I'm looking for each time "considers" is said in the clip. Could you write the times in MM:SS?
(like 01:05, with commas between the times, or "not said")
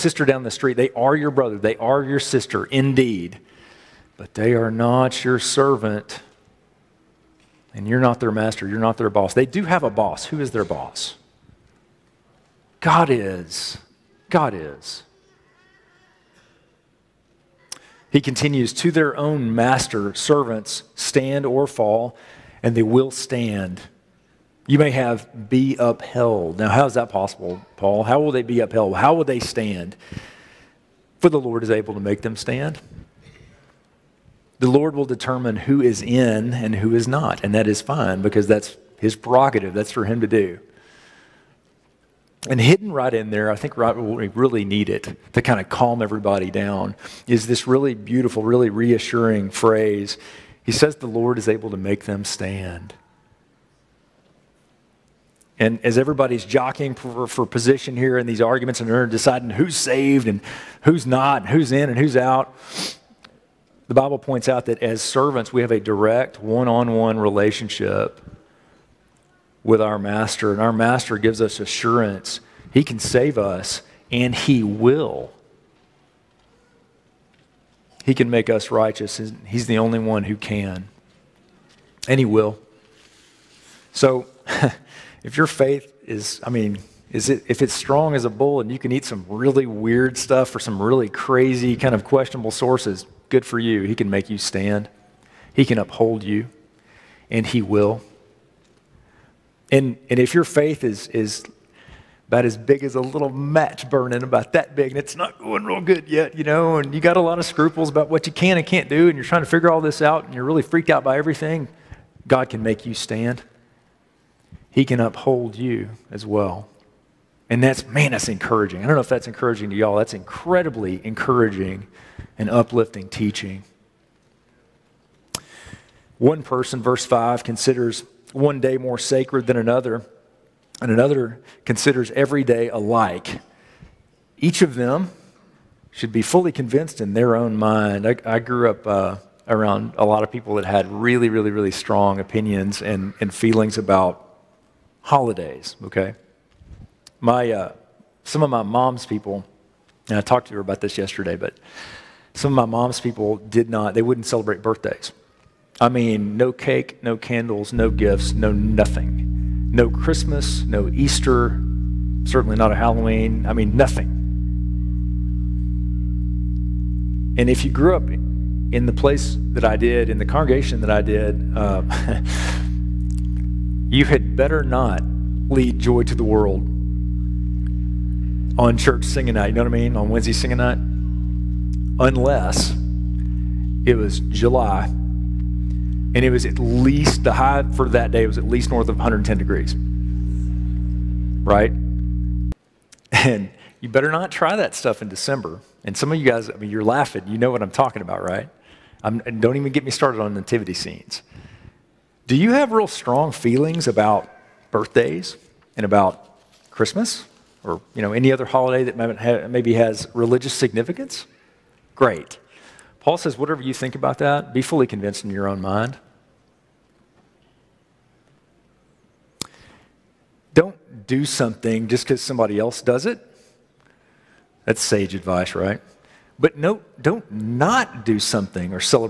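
02:07, 02:11.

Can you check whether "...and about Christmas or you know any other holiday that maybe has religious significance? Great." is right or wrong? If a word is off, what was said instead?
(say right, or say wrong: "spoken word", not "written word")
right.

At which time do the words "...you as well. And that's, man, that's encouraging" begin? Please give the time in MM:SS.
01:55.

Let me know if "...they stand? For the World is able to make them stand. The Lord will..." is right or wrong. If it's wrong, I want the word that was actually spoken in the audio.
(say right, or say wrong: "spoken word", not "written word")
wrong: "Lord", not "World".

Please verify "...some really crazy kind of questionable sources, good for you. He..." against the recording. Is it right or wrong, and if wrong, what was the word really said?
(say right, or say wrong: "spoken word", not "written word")
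right.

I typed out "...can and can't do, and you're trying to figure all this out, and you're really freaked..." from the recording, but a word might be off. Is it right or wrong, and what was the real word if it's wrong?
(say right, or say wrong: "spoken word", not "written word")
right.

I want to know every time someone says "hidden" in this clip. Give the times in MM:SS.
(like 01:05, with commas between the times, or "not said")
00:42.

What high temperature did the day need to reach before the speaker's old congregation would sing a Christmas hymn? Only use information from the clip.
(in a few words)
110 degrees.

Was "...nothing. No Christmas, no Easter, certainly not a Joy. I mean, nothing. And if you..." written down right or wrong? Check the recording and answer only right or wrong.
wrong.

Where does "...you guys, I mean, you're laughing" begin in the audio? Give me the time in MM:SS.
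03:16.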